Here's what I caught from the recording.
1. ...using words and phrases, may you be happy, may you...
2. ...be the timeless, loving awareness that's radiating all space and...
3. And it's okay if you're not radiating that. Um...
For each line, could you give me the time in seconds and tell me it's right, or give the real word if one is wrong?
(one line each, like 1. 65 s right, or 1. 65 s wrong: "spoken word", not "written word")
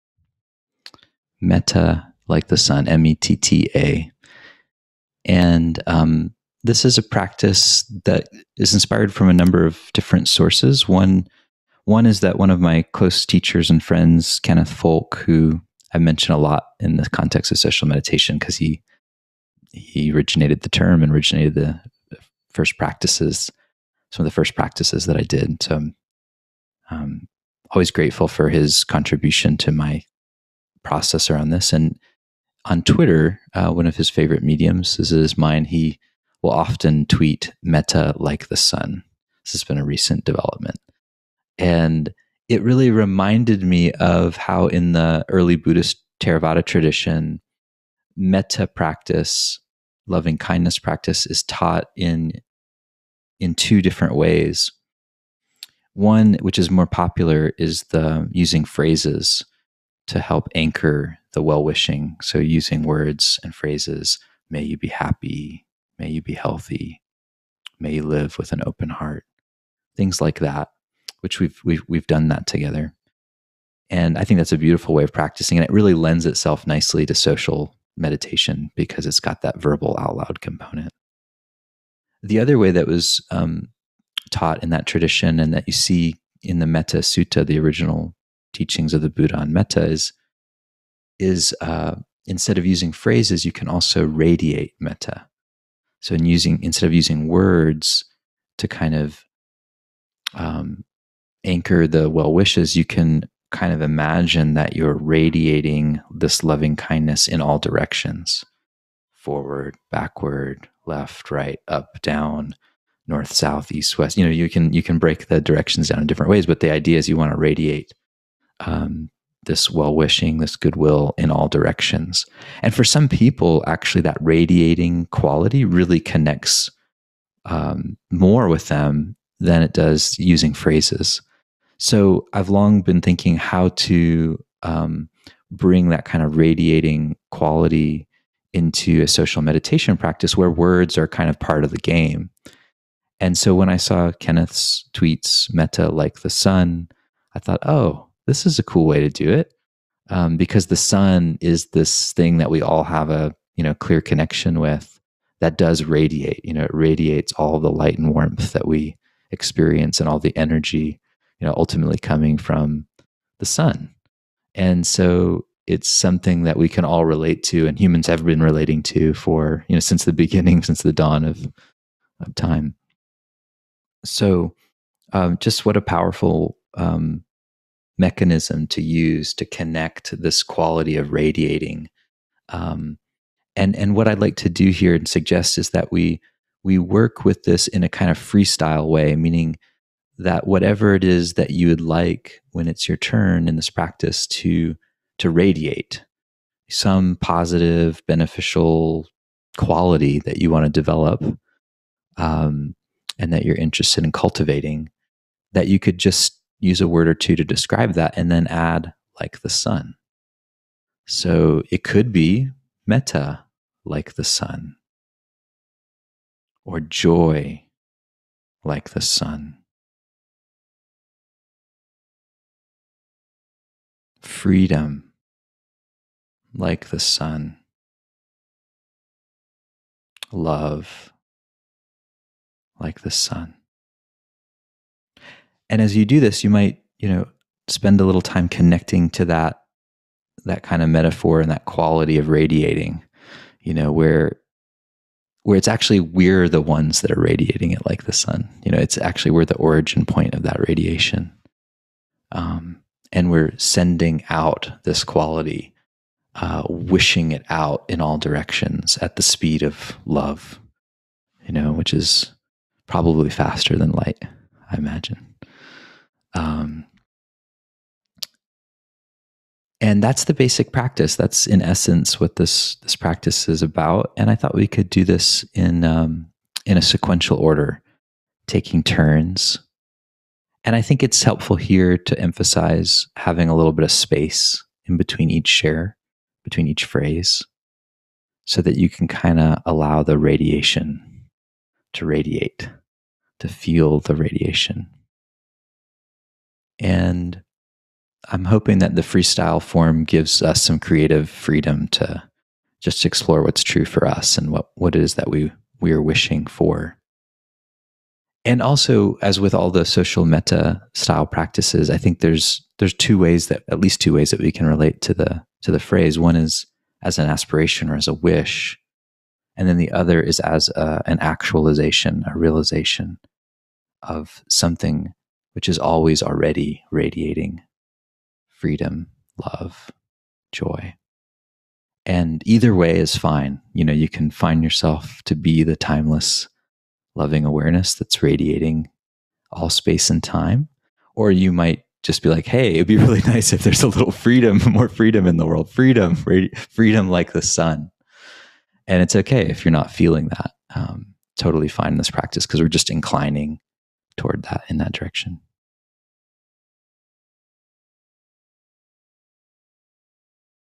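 1. 62 s right
2. 335 s right
3. 348 s wrong: "feeling", not "radiating".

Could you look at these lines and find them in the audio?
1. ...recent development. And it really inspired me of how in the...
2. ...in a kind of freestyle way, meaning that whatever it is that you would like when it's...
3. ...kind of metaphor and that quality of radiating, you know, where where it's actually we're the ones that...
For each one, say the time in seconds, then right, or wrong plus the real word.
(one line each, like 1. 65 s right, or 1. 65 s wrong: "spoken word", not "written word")
1. 39 s wrong: "reminded", not "inspired"
2. 187 s right
3. 240 s right.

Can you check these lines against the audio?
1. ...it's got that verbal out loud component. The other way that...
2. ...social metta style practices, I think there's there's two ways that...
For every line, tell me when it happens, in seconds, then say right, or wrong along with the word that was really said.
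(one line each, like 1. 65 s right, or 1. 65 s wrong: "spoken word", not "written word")
1. 79 s right
2. 309 s right.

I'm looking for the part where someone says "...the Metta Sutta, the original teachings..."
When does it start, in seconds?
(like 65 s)
86 s.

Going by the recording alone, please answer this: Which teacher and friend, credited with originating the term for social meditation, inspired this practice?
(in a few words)
Kenneth Folk.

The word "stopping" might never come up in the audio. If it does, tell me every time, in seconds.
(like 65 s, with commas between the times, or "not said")
not said.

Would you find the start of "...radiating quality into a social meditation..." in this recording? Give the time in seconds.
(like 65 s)
136 s.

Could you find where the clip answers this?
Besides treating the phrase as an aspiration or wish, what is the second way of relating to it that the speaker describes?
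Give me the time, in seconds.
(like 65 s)
321 s.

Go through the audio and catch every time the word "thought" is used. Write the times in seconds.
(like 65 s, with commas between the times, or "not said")
147 s, 274 s.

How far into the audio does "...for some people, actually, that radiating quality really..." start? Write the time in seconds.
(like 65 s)
122 s.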